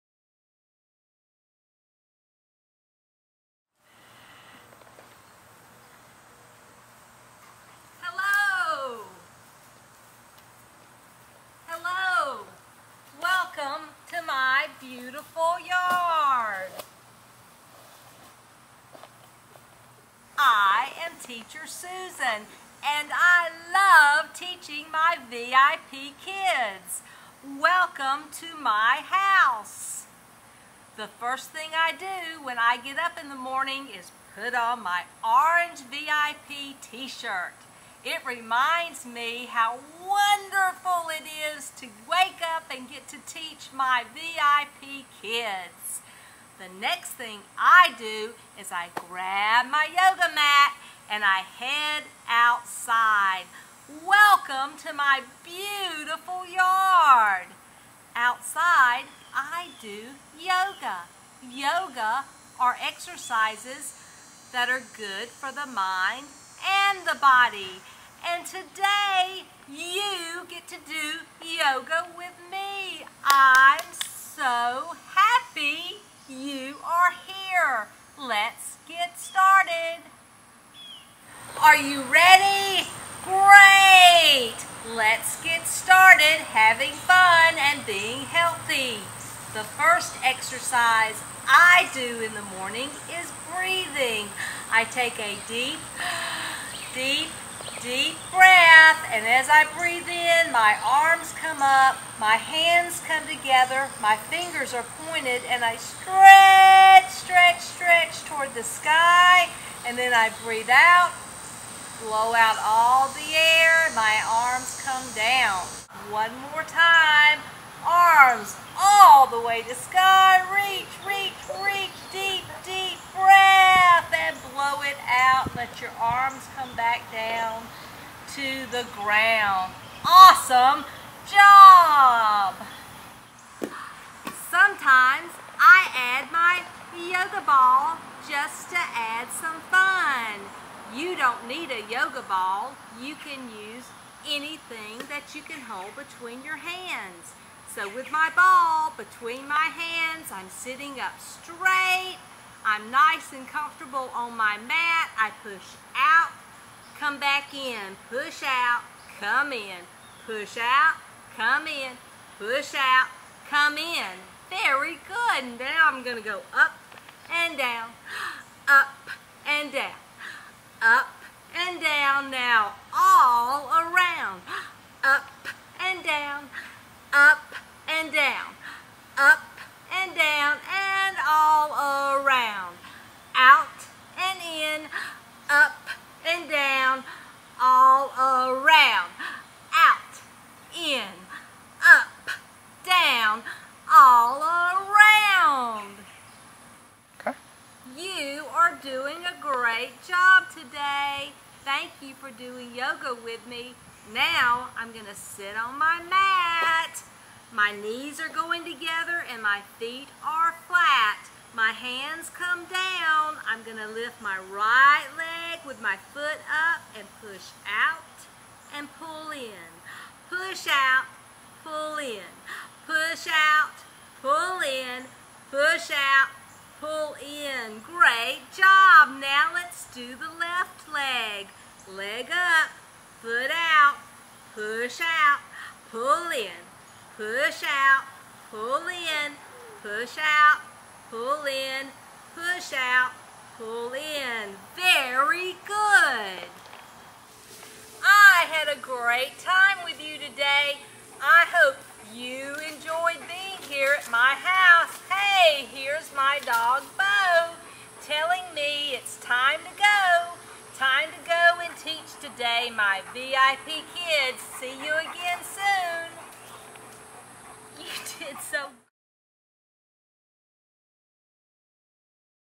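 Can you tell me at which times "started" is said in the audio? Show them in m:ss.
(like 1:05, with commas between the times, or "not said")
1:19, 1:25.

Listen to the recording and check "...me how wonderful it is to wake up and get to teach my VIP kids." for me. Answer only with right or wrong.
right.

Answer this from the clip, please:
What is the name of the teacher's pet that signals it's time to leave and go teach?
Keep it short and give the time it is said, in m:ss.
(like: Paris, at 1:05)
Bo, at 4:16.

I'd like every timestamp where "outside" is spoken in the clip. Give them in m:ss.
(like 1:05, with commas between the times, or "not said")
0:52, 0:58.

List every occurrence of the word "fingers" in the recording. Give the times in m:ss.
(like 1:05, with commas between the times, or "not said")
1:44.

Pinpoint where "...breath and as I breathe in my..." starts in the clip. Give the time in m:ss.
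1:38.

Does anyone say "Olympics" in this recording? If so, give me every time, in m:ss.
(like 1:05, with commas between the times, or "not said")
not said.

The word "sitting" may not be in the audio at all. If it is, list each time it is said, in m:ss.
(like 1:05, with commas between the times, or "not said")
2:30.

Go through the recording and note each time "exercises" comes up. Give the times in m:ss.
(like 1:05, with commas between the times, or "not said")
1:02, 1:30.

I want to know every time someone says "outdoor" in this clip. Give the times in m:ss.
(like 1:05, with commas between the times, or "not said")
not said.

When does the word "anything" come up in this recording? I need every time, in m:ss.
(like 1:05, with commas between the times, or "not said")
2:24.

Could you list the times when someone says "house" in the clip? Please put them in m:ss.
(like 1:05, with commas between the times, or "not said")
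0:29, 4:14.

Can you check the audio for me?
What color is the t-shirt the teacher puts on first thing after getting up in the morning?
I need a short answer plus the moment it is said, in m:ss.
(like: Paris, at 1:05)
Orange, at 0:35.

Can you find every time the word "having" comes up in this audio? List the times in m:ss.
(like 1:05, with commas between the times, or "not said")
1:26.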